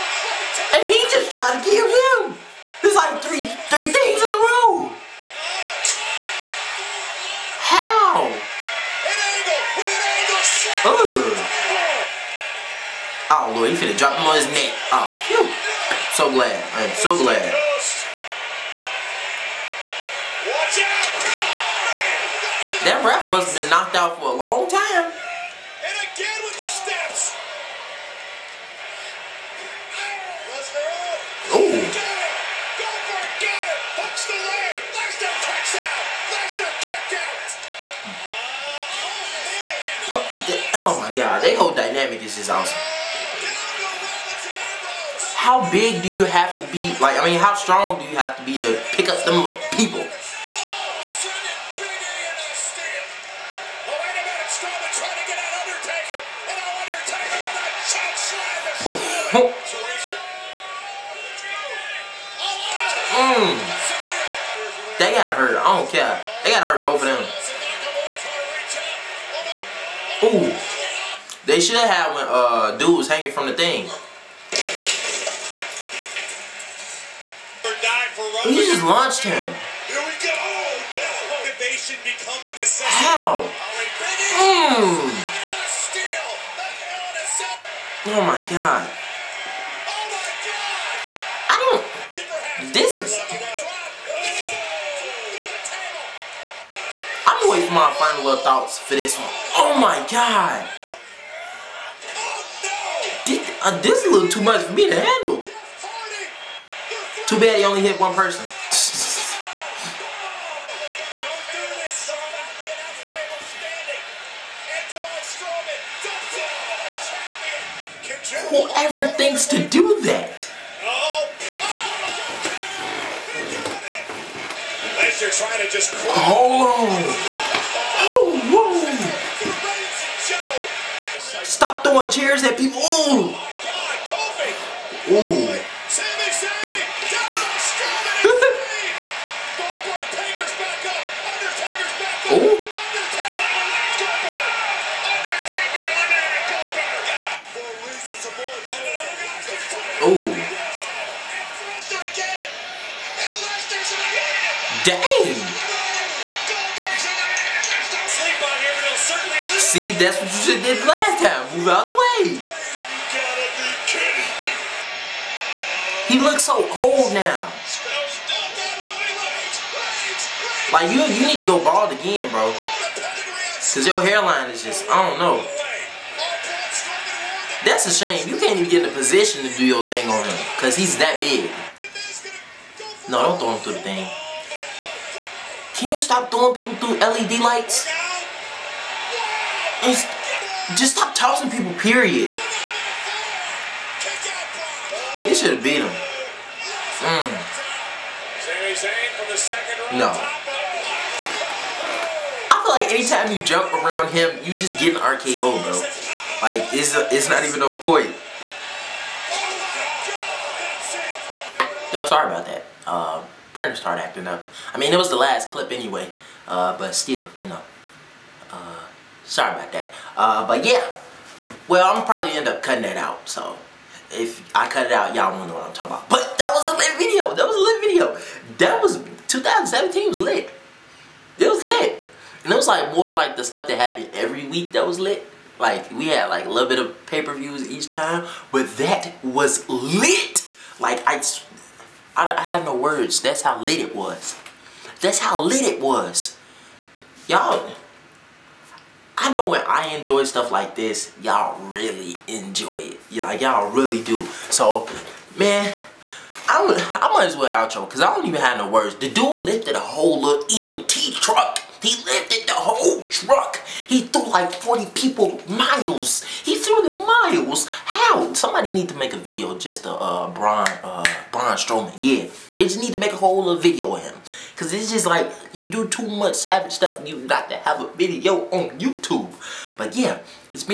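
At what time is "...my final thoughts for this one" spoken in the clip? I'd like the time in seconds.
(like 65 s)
97 s.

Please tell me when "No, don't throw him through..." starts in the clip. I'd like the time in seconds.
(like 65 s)
183 s.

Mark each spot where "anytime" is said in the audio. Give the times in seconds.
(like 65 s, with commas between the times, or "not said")
202 s.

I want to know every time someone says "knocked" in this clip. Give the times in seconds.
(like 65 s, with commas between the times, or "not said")
23 s.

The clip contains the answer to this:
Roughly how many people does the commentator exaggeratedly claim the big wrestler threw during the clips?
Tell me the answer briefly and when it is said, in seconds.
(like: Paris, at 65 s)
40, at 264 s.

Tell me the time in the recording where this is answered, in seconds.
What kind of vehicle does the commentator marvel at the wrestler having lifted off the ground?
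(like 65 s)
260 s.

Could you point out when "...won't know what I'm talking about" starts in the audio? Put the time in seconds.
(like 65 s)
225 s.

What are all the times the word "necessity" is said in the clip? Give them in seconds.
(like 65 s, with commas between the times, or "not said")
82 s.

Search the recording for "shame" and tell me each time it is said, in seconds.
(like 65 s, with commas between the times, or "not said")
177 s.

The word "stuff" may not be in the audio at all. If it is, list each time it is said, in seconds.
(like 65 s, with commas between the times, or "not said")
233 s, 250 s, 276 s.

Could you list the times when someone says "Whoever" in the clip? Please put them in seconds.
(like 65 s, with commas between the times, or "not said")
118 s.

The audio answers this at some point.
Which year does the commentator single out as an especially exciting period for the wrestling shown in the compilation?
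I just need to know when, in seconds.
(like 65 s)
229 s.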